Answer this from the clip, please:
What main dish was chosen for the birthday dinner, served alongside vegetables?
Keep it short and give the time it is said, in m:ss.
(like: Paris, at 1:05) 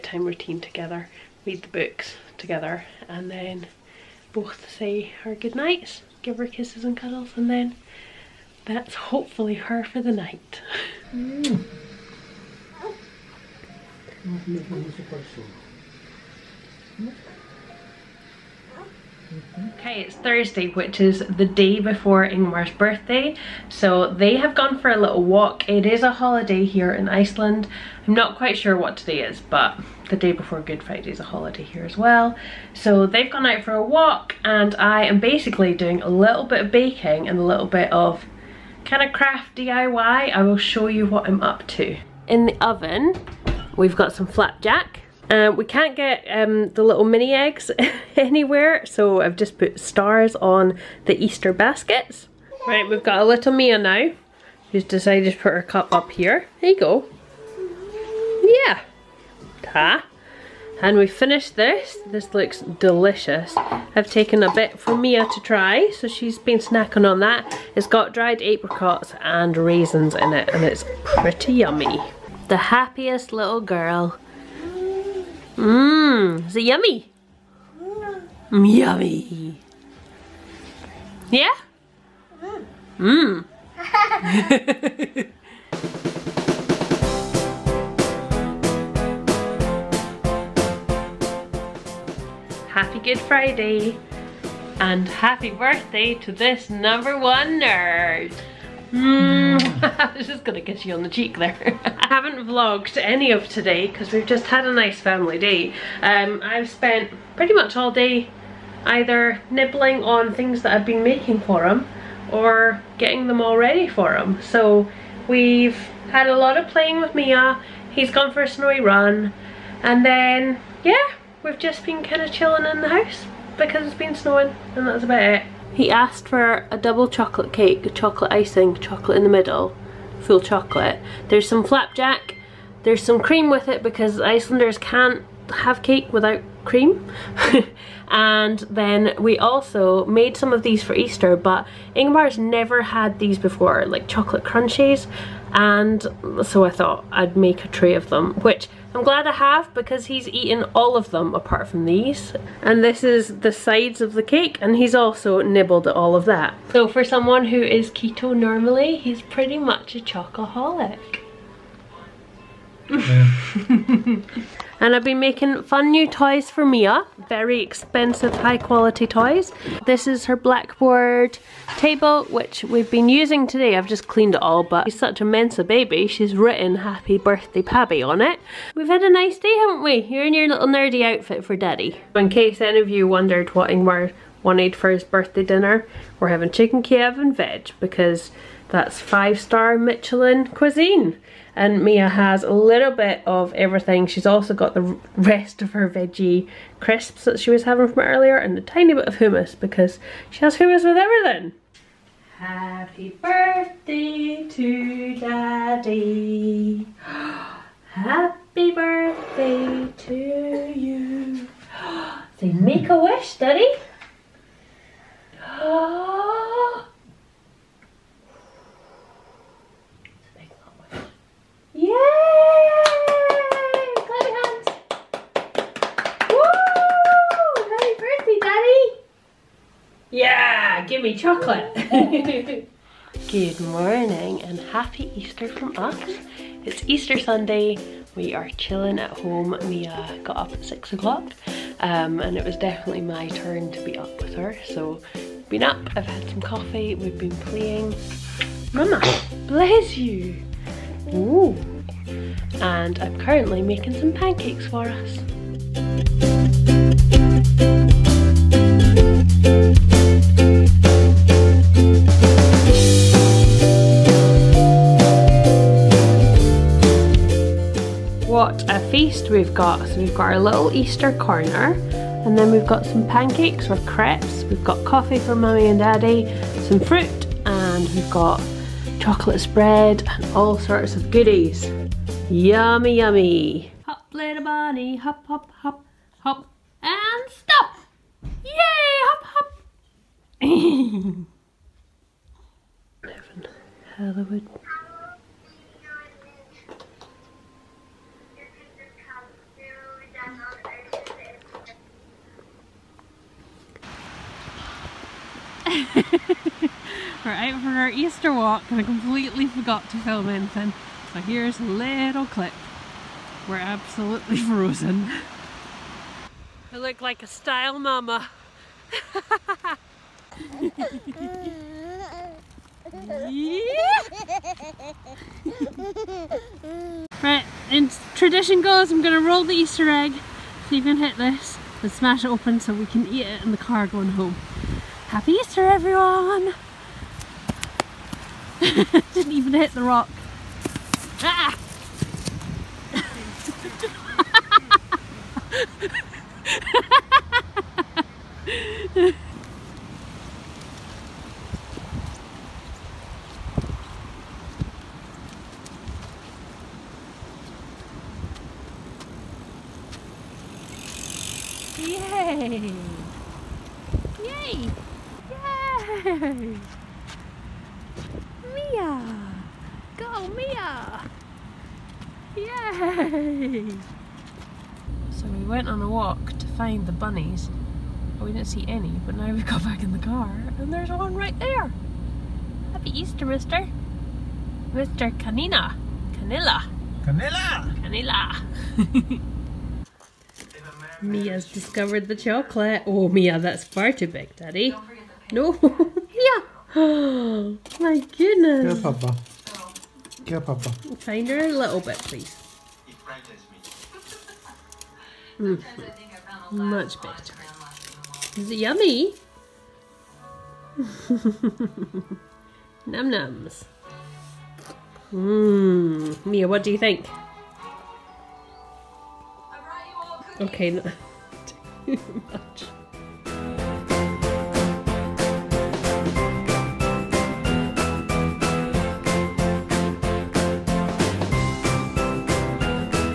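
chicken Kiev, at 3:06.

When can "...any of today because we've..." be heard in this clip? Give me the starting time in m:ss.
1:42.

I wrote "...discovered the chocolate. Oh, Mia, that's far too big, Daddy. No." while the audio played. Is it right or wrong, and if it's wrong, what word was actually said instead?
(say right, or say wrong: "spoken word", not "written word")
right.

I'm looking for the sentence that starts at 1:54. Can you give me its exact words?
So we've had a lot of playing with Mia.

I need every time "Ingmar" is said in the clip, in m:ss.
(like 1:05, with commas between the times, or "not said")
0:22, 2:21, 3:03.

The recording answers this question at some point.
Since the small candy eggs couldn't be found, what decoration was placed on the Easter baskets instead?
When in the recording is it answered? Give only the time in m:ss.
0:49.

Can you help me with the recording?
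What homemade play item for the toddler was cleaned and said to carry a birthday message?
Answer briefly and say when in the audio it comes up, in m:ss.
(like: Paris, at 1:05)
blackboard table, at 2:50.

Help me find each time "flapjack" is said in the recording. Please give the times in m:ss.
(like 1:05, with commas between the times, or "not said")
0:44, 2:11.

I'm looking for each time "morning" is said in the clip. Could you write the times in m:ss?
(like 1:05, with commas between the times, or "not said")
3:53.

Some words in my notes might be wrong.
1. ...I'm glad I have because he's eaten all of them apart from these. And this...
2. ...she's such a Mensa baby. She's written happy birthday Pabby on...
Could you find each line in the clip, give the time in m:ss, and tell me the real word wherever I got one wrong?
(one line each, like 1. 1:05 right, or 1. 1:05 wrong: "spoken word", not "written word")
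1. 2:28 right
2. 2:54 right.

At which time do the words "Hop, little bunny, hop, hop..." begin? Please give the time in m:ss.
4:43.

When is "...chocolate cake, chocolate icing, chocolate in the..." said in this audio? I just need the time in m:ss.
2:07.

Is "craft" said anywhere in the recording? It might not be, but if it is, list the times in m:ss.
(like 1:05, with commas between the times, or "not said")
0:39.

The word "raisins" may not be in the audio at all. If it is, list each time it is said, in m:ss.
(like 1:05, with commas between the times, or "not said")
1:09.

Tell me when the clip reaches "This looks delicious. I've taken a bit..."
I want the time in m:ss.
1:02.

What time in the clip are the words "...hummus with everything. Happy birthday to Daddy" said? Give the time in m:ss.
3:20.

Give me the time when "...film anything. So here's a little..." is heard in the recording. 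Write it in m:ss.
5:09.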